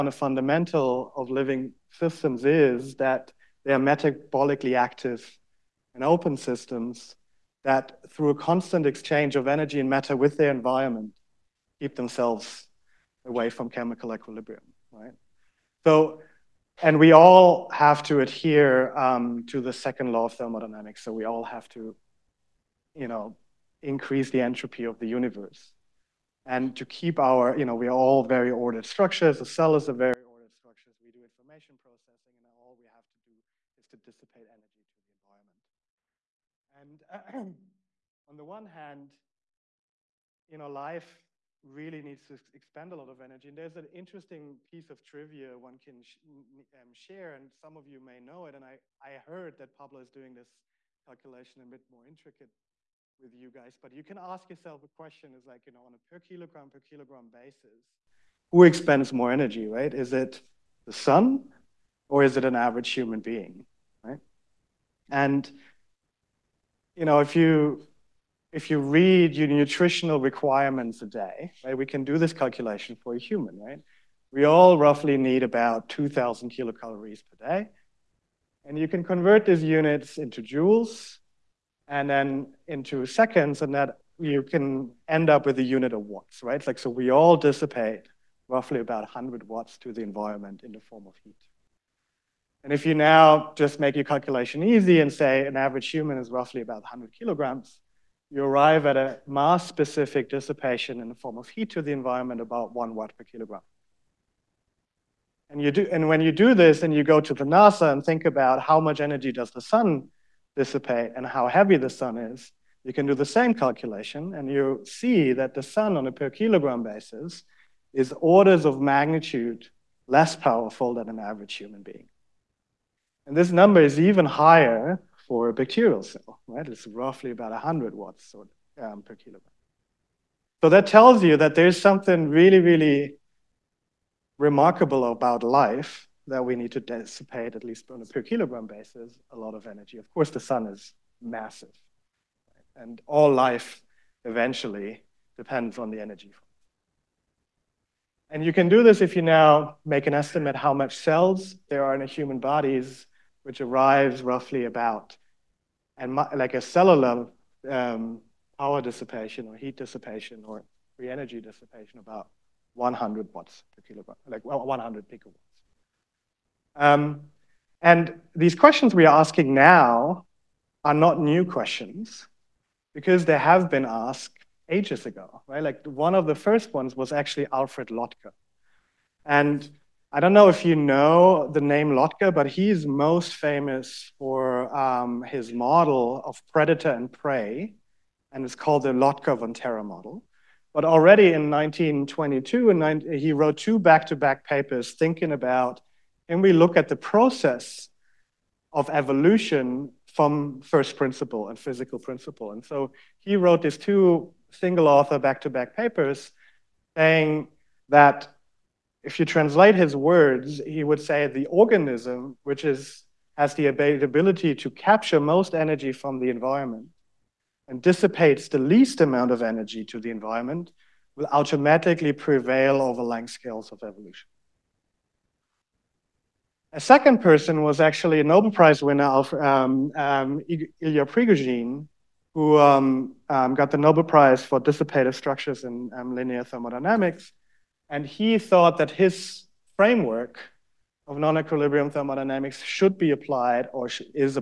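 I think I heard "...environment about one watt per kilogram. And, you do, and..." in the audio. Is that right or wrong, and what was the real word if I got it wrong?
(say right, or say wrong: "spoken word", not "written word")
right.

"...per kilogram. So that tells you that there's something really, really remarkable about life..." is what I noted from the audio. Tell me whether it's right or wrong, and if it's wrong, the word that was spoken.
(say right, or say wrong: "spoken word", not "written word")
right.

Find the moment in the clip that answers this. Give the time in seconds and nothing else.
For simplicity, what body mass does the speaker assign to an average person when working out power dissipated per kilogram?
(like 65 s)
96 s.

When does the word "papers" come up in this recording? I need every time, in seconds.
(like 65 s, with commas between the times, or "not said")
194 s, 205 s.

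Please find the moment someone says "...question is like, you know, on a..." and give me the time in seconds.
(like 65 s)
54 s.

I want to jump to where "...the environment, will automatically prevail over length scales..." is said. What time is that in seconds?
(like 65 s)
219 s.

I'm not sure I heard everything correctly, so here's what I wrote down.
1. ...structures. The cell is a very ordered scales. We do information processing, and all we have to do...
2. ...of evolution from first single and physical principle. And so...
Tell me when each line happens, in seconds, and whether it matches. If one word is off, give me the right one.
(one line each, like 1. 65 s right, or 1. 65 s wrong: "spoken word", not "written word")
1. 28 s wrong: "structures", not "scales"
2. 198 s wrong: "principle", not "single".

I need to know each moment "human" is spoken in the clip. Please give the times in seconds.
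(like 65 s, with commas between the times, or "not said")
62 s, 73 s, 95 s, 121 s, 152 s.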